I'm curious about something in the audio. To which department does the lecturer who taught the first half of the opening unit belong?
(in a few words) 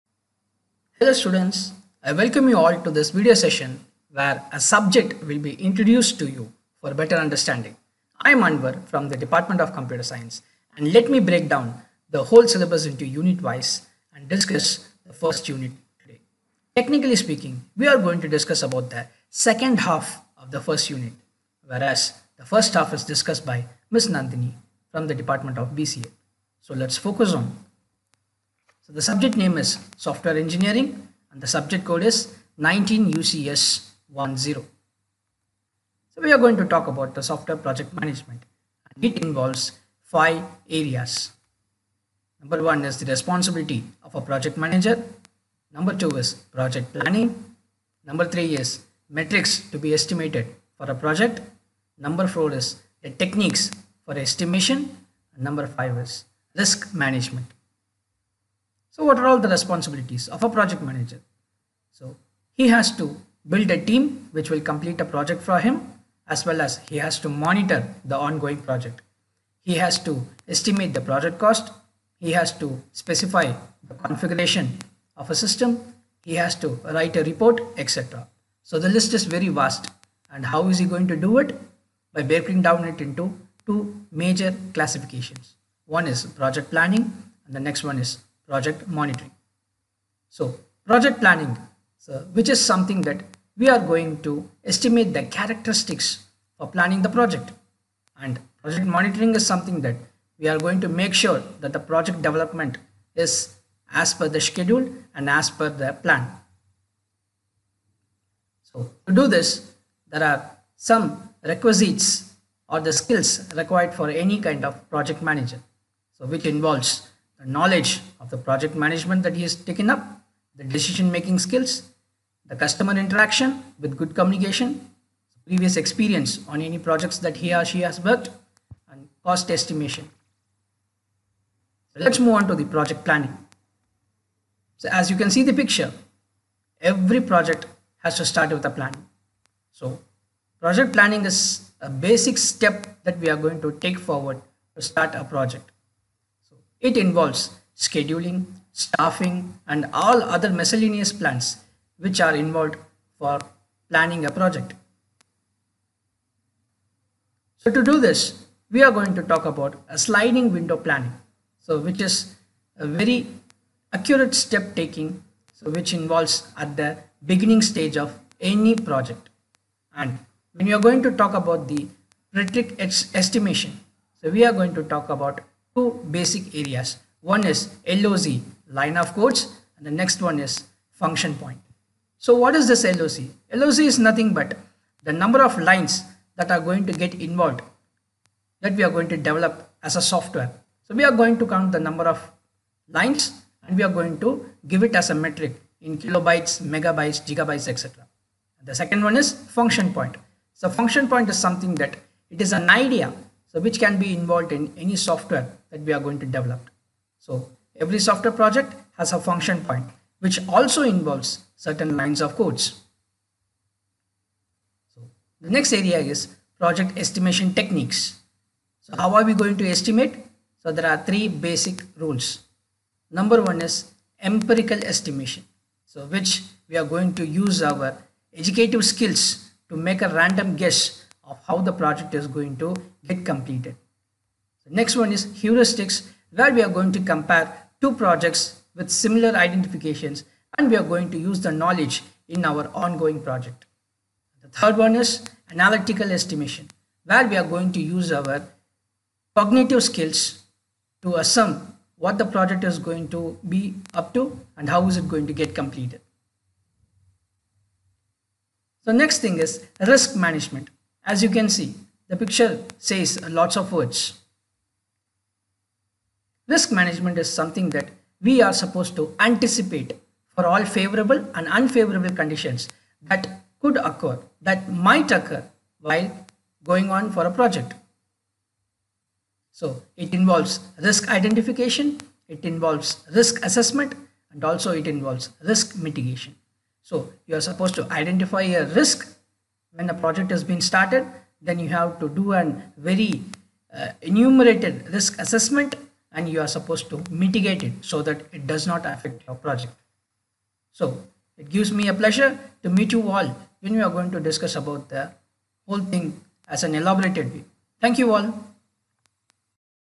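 BCA.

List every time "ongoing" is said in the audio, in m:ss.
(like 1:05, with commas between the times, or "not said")
1:08, 4:02.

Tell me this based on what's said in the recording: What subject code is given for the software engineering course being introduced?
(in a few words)
19 UCS 10.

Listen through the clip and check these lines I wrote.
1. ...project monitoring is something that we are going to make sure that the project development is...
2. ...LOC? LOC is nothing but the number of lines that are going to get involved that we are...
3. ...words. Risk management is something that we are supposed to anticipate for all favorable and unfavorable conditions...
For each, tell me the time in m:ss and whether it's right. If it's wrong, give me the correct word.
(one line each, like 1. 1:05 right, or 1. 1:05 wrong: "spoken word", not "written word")
1. 1:38 right
2. 3:02 right
3. 4:23 right.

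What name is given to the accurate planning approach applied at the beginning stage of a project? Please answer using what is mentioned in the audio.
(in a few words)
sliding window planning.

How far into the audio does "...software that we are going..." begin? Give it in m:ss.
3:24.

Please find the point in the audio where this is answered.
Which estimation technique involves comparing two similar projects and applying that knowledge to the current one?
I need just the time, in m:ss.
3:55.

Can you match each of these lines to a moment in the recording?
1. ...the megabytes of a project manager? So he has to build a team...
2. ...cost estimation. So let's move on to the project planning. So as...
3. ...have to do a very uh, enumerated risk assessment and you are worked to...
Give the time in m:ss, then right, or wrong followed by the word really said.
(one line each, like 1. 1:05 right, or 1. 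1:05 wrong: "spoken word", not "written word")
1. 0:59 wrong: "responsibilities", not "megabytes"
2. 2:09 right
3. 4:51 wrong: "supposed", not "worked".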